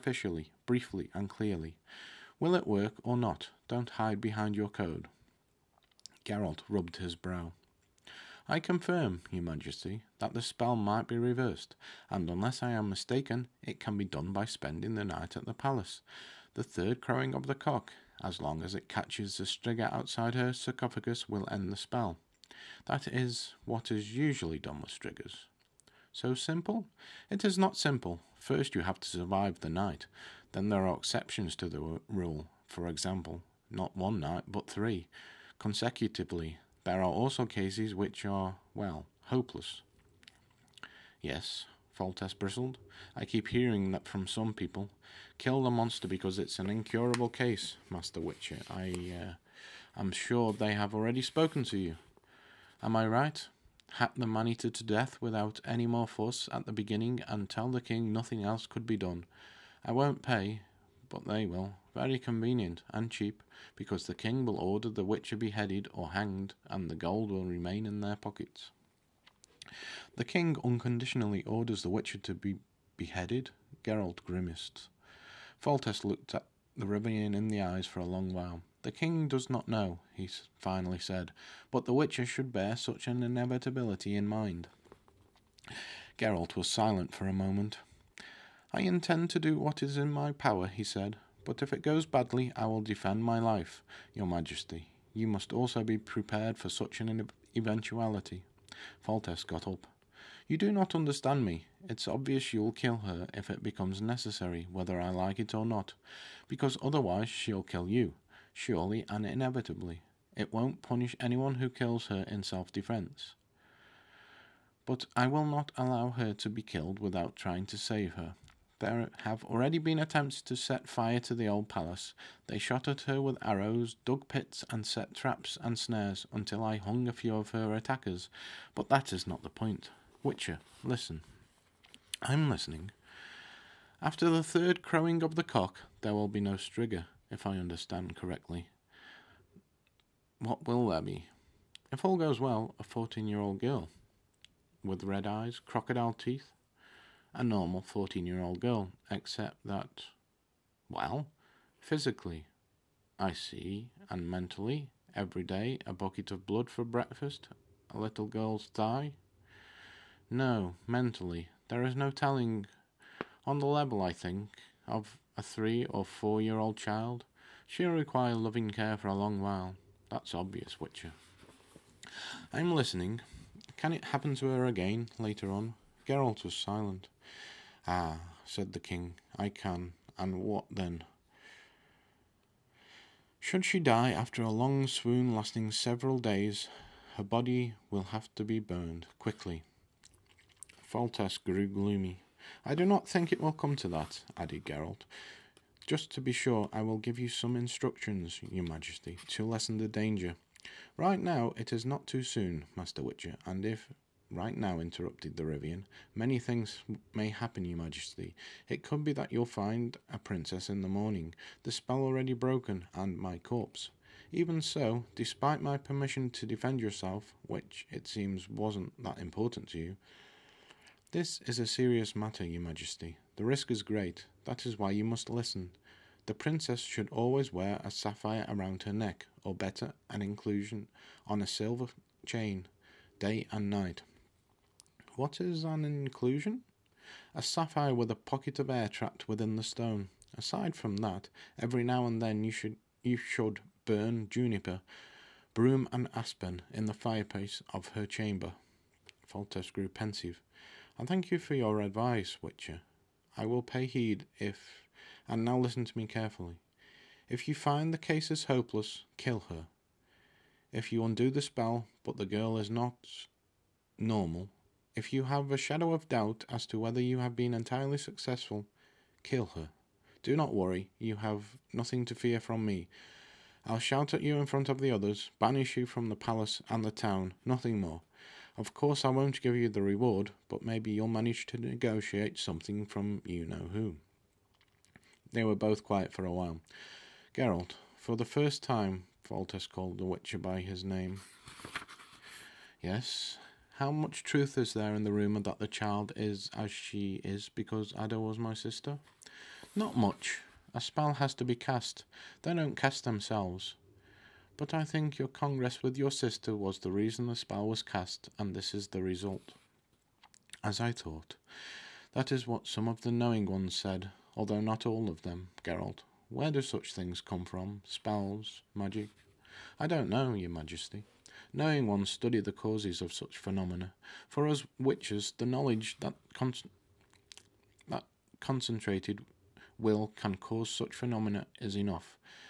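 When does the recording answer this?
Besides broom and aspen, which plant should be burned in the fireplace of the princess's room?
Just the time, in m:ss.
4:04.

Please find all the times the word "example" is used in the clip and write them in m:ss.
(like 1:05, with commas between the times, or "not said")
0:32.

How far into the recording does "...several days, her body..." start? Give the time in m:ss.
3:05.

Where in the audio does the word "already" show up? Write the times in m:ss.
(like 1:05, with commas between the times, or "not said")
0:50, 1:59, 3:31.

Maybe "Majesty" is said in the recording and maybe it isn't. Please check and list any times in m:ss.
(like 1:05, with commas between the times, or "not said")
0:09, 1:34, 3:18, 3:27, 3:42, 5:20.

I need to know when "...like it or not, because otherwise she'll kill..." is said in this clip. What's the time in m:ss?
1:45.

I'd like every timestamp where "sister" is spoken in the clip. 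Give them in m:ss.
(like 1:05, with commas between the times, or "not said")
4:58, 5:06.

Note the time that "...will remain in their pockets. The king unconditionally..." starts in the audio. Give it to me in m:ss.
1:07.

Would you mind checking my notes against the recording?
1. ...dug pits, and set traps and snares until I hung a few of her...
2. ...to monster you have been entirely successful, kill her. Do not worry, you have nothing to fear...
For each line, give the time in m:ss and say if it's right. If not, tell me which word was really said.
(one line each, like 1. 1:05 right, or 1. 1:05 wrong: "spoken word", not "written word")
1. 2:04 right
2. 4:26 wrong: "whether", not "monster".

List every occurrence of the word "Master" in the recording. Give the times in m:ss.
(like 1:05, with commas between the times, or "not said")
0:47, 3:22.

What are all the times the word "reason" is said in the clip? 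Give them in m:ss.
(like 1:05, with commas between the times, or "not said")
5:06.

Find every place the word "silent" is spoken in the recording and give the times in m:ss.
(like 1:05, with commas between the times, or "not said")
1:26, 2:56.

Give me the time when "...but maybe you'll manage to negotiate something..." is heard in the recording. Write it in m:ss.
4:40.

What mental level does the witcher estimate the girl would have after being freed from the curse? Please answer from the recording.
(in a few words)
Three or four year old.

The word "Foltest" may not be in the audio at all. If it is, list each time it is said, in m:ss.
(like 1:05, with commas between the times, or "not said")
0:42, 1:15, 1:39, 3:10, 4:09, 4:49.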